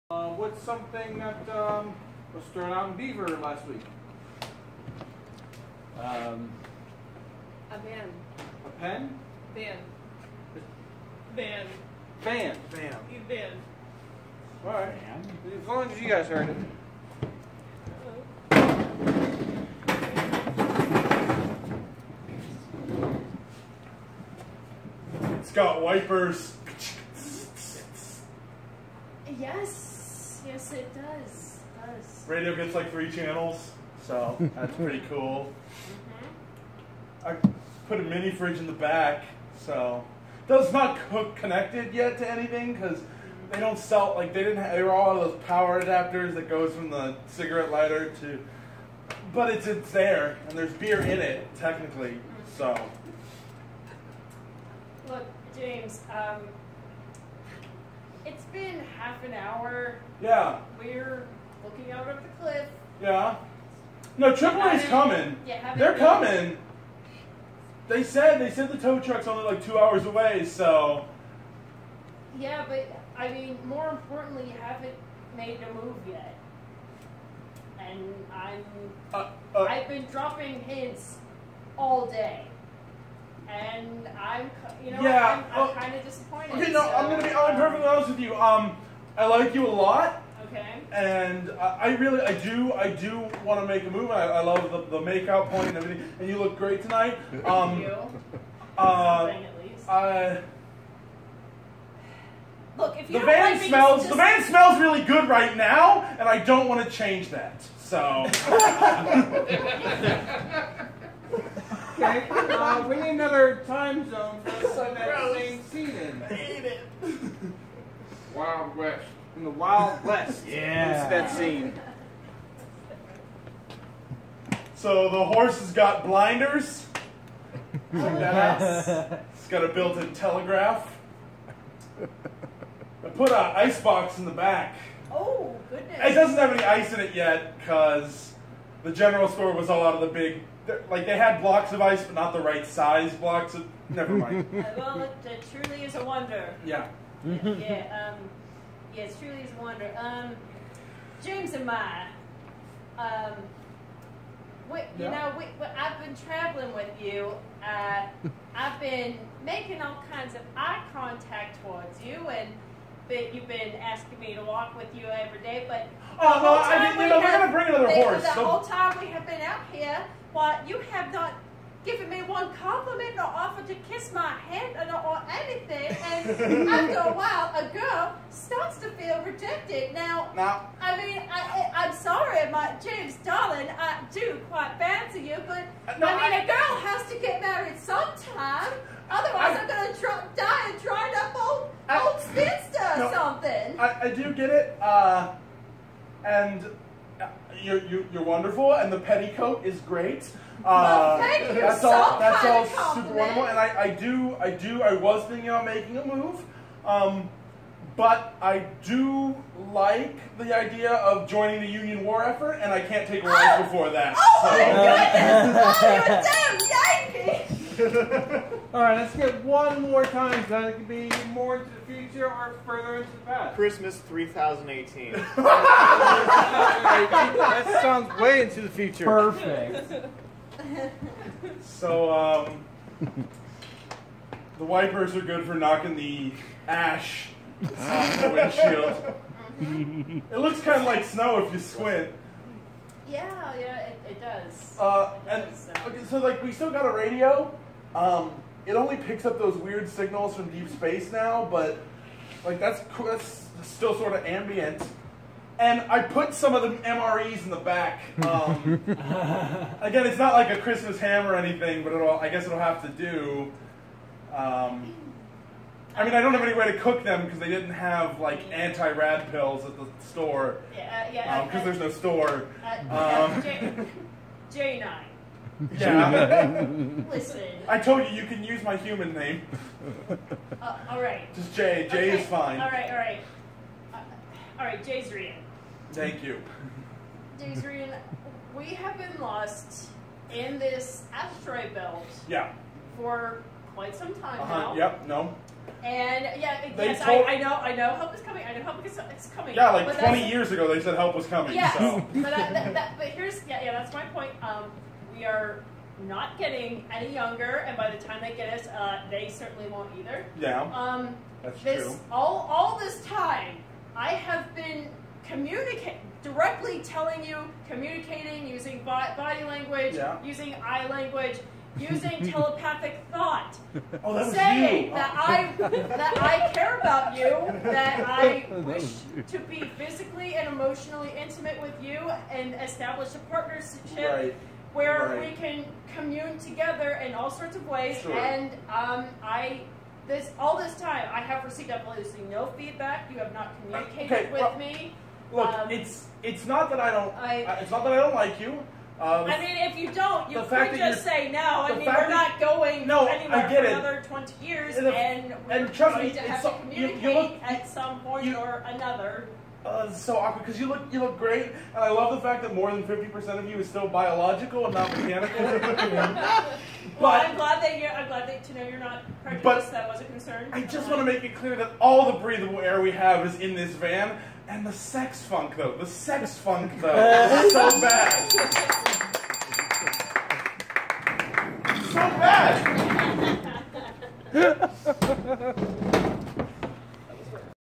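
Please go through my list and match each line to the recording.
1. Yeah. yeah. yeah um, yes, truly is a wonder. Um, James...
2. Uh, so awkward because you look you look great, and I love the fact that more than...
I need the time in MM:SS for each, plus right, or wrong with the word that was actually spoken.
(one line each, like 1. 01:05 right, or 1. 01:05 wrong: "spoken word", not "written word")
1. 02:26 right
2. 05:59 right.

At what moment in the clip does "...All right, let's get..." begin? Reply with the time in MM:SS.
03:38.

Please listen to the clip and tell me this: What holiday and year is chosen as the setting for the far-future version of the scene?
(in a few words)
Christmas 3018.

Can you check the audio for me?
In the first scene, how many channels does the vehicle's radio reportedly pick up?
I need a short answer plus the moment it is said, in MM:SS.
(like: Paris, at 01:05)
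3, at 00:32.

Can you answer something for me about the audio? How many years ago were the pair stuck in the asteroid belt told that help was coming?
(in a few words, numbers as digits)
20.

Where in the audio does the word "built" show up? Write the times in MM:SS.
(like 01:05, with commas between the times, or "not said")
02:09.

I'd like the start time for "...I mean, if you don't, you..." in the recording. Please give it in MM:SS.
05:49.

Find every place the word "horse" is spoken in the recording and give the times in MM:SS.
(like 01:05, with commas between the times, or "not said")
02:05, 02:47.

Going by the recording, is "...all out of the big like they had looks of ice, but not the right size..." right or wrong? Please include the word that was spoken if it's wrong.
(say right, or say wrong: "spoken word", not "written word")
wrong: "blocks", not "looks".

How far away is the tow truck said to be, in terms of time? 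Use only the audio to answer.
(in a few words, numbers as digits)
2 hours.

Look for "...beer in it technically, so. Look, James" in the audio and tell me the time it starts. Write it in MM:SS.
00:50.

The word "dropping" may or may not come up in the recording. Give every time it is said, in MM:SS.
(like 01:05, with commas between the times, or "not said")
01:20.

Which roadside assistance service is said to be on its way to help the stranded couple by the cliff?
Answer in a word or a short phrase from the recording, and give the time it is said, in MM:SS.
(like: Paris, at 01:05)
Triple A, at 01:04.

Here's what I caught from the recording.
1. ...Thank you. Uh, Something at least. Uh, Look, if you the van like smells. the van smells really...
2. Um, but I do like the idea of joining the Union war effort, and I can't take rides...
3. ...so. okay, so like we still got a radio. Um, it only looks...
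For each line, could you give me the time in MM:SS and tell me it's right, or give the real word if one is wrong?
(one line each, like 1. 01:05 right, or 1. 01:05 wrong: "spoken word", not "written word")
1. 01:39 right
2. 03:26 right
3. 04:05 wrong: "picks", not "looks".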